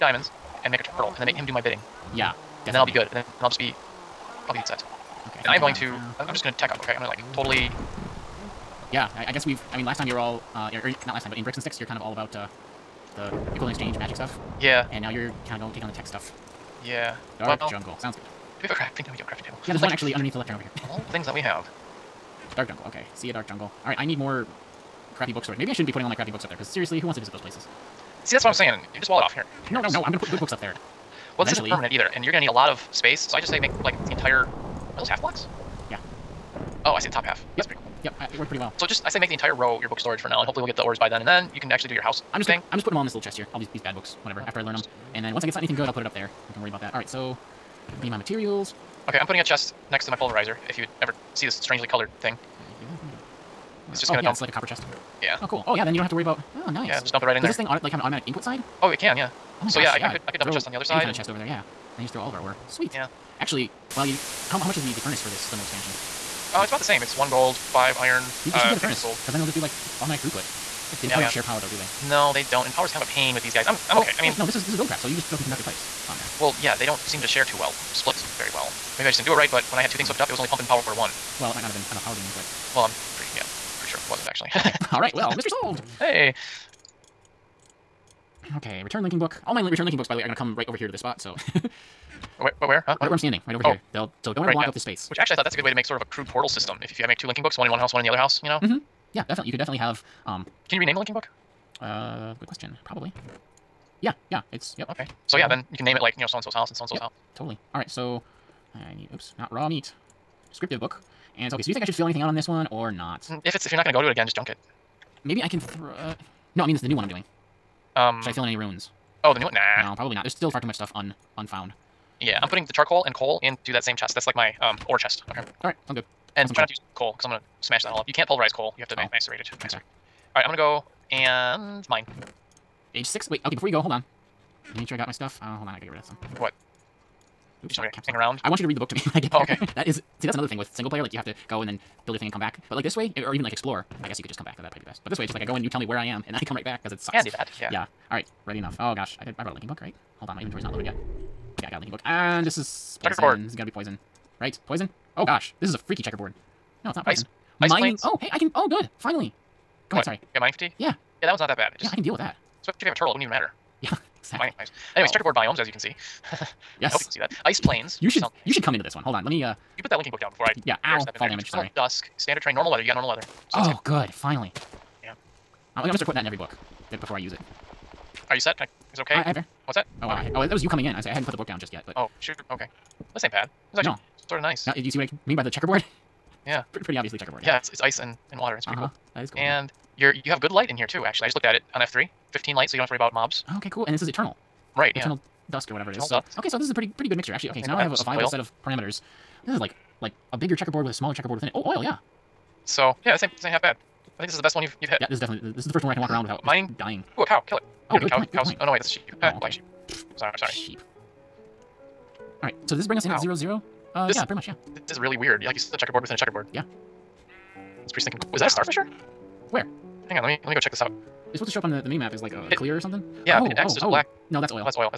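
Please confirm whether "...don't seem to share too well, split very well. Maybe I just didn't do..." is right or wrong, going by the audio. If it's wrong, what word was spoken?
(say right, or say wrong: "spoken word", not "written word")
right.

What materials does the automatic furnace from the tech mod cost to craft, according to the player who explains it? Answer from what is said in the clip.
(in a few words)
1 gold, 5 iron.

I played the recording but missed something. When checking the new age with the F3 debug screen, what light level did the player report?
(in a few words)
15.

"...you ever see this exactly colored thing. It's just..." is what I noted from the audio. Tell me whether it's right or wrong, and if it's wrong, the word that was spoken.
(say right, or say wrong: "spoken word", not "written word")
wrong: "strangely", not "exactly".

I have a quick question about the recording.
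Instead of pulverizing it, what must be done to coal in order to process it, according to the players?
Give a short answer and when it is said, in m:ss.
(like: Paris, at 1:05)
Macerate it, at 2:09.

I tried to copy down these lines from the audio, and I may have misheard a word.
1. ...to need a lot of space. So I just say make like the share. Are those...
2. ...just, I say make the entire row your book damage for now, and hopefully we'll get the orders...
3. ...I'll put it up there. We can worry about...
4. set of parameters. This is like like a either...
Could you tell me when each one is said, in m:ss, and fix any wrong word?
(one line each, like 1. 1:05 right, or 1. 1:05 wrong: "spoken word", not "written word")
1. 0:32 wrong: "entire", not "share"
2. 0:38 wrong: "storage", not "damage"
3. 0:45 right
4. 3:18 wrong: "bigger", not "either".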